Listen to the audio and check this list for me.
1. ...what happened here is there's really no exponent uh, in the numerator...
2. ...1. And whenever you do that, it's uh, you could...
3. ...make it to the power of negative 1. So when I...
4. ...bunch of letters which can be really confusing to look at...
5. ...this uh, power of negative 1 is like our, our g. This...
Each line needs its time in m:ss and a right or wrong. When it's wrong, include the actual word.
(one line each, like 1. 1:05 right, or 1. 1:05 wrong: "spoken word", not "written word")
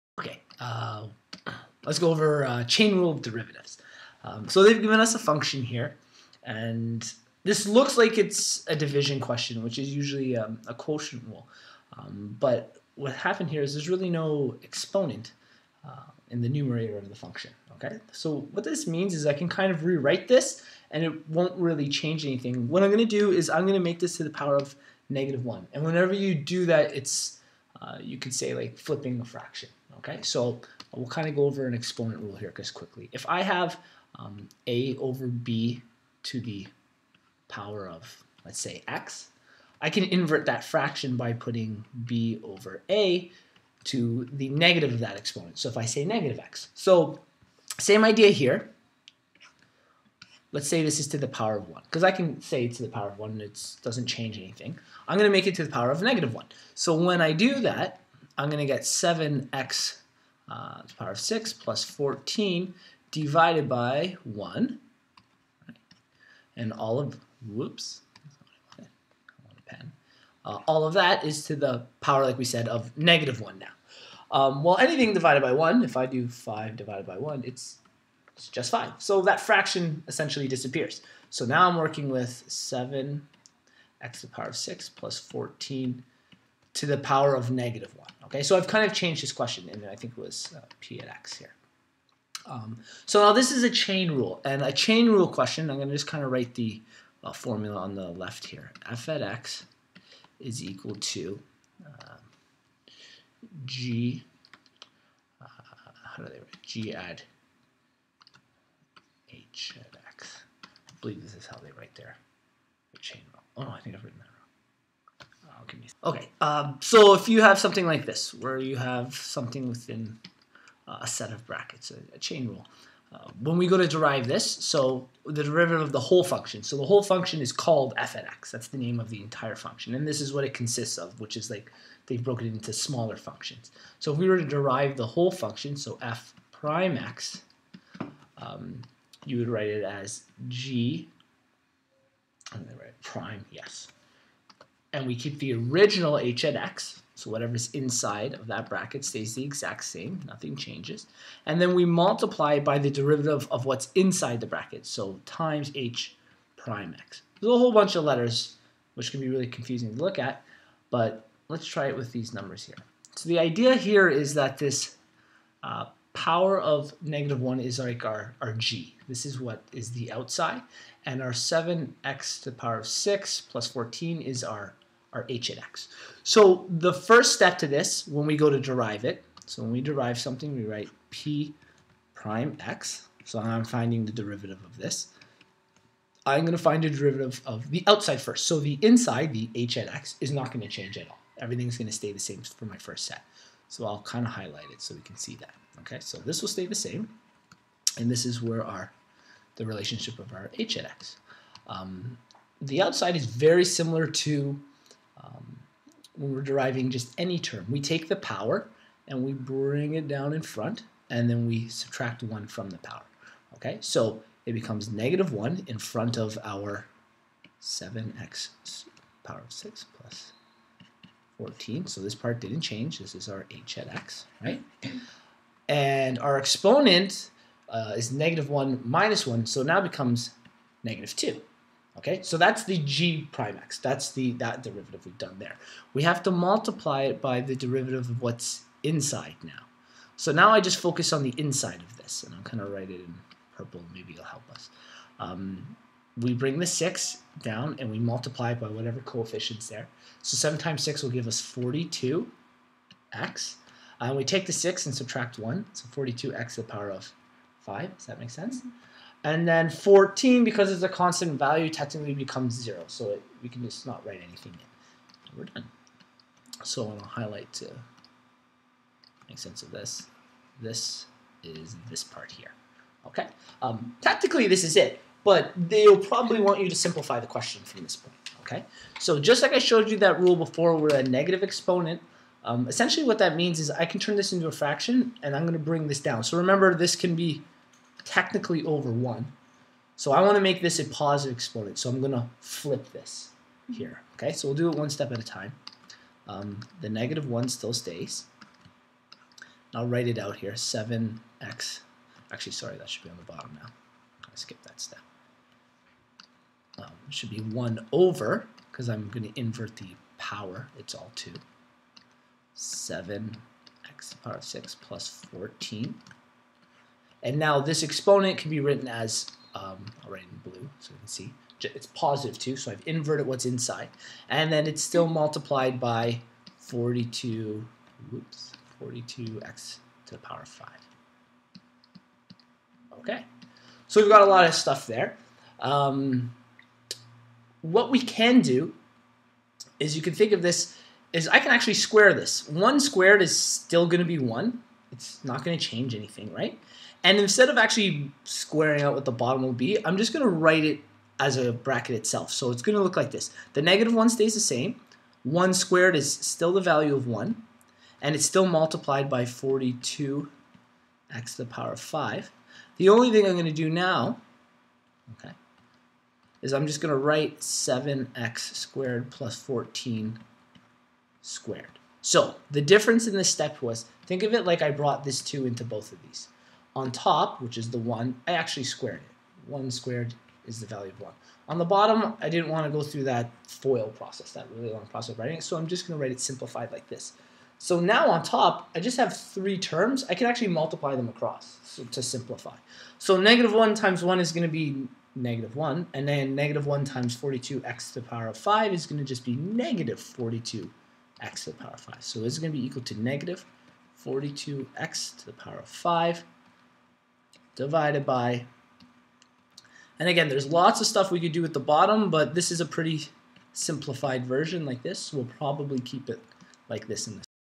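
1. 0:12 right
2. 0:25 right
3. 0:55 right
4. 2:37 right
5. 2:44 right.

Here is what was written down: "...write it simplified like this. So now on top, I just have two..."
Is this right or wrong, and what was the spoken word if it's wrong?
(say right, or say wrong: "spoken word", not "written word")
wrong: "three", not "two".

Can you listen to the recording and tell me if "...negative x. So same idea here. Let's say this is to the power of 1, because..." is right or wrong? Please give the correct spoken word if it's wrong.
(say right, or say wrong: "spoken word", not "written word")
right.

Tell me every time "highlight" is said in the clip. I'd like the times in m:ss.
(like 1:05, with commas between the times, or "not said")
3:14, 4:27.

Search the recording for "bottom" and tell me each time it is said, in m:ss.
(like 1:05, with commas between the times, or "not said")
5:03, 5:49, 6:21, 6:51.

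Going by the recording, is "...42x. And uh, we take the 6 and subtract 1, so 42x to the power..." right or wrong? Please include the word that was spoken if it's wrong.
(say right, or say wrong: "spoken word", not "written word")
right.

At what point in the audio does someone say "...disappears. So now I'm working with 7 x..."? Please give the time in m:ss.
1:20.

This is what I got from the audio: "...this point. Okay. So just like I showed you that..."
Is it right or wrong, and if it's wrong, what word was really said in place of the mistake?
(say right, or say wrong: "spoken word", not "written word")
right.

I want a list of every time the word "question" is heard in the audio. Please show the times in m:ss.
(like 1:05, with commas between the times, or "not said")
0:09, 1:29, 1:35, 4:37.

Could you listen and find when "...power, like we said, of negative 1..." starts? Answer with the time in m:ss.
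1:12.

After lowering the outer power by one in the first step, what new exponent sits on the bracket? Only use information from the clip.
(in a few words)
-2.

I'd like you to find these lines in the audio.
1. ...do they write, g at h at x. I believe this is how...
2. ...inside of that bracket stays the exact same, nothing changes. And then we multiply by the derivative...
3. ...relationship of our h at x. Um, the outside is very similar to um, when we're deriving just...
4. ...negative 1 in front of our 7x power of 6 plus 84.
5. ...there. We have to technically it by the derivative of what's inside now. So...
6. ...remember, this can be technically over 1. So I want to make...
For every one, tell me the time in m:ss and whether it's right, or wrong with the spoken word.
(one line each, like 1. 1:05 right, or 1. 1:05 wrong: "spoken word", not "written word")
1. 1:46 right
2. 2:27 right
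3. 3:19 right
4. 3:34 wrong: "14", not "84"
5. 3:55 wrong: "multiply", not "technically"
6. 4:46 right.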